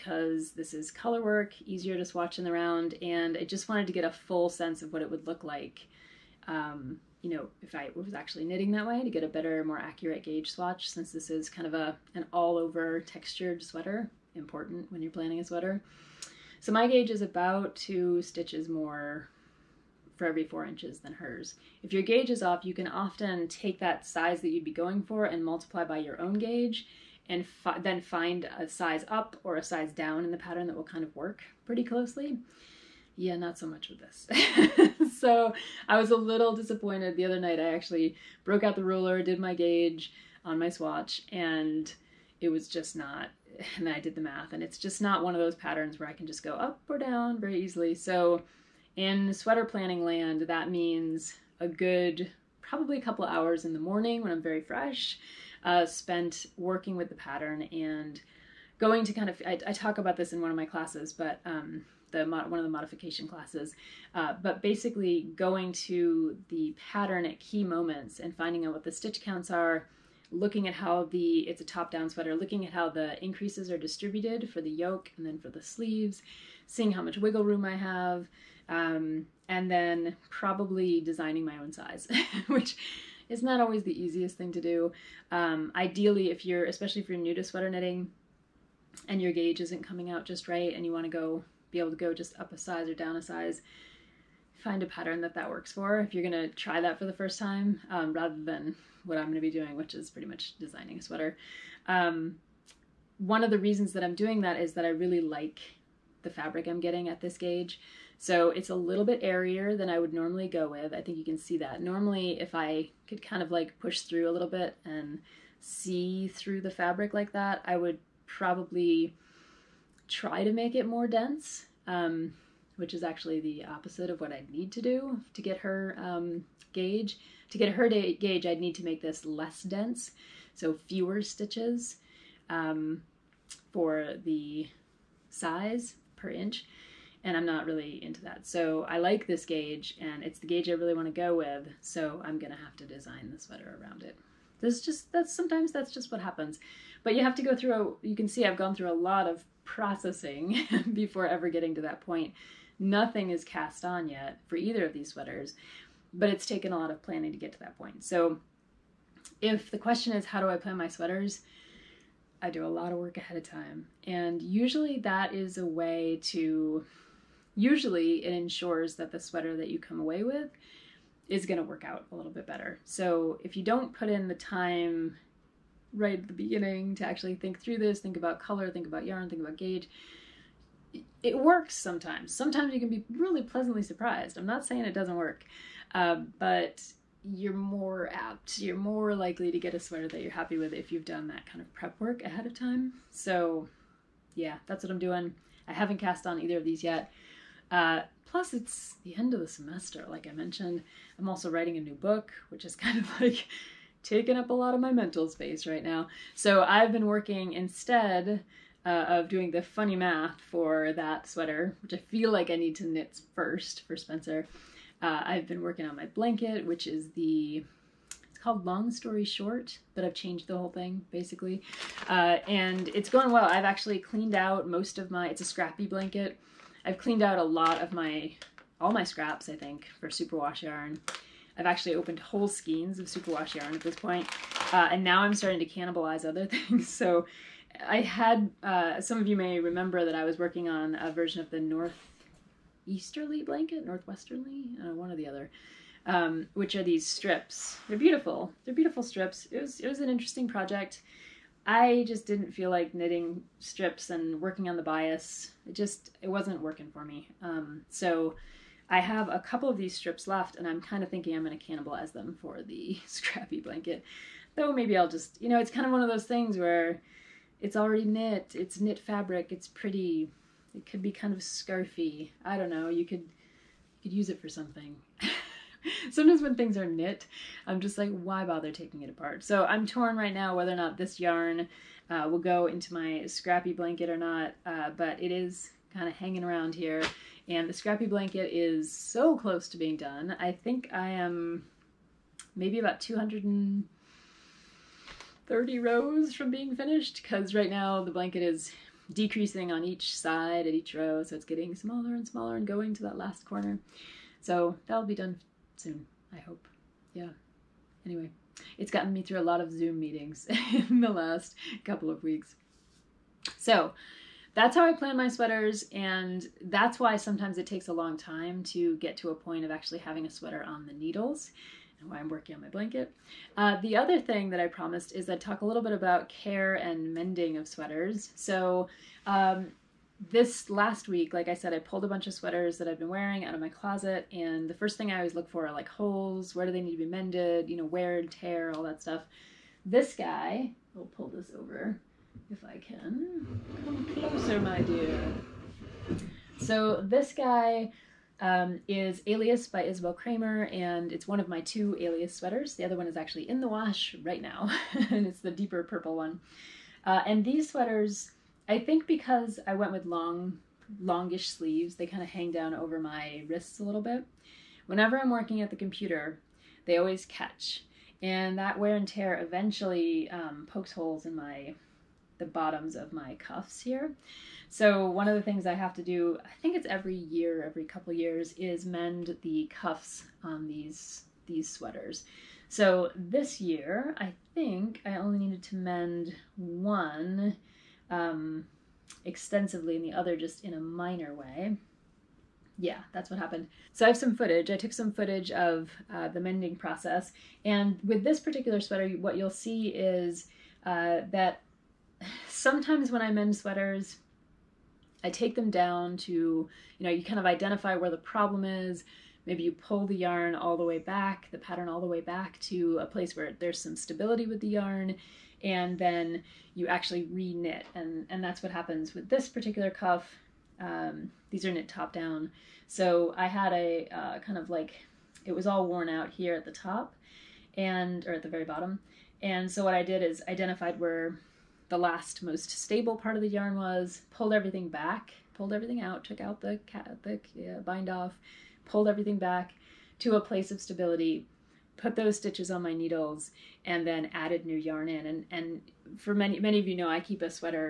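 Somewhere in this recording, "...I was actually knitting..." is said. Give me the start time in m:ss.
0:07.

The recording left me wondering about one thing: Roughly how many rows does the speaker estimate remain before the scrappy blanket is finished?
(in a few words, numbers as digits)
230.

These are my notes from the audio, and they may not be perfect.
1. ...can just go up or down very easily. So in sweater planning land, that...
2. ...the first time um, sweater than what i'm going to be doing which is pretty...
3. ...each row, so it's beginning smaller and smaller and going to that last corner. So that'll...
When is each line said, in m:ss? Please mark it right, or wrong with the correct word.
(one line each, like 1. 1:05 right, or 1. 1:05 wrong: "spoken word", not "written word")
1. 0:46 right
2. 1:37 wrong: "rather", not "sweater"
3. 5:00 wrong: "getting", not "beginning".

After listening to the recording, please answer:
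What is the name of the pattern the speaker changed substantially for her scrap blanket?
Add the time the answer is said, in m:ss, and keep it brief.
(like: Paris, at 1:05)
Long Story Short, at 3:38.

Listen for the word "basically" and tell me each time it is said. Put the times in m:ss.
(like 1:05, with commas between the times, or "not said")
1:04, 3:41.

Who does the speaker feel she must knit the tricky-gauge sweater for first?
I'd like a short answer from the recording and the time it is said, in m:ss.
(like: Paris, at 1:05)
Spencer, at 3:33.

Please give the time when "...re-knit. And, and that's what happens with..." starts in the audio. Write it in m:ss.
6:57.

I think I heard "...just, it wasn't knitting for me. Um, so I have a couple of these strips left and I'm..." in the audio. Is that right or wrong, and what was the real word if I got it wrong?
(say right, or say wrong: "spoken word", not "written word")
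wrong: "working", not "knitting".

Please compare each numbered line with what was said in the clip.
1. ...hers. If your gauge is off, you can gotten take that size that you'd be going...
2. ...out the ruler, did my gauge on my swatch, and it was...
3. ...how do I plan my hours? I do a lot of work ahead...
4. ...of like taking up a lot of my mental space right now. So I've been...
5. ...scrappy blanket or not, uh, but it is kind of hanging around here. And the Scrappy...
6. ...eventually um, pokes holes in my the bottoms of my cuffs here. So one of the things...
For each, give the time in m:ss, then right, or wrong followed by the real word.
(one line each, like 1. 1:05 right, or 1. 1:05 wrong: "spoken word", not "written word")
1. 0:21 wrong: "often", not "gotten"
2. 0:38 right
3. 2:40 wrong: "sweaters", not "hours"
4. 3:22 right
5. 4:43 right
6. 6:09 right.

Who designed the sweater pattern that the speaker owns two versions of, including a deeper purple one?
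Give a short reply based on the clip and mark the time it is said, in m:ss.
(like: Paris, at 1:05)
Isabell Kraemer, at 5:49.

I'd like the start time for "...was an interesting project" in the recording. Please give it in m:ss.
4:09.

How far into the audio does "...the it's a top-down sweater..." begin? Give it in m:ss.
1:11.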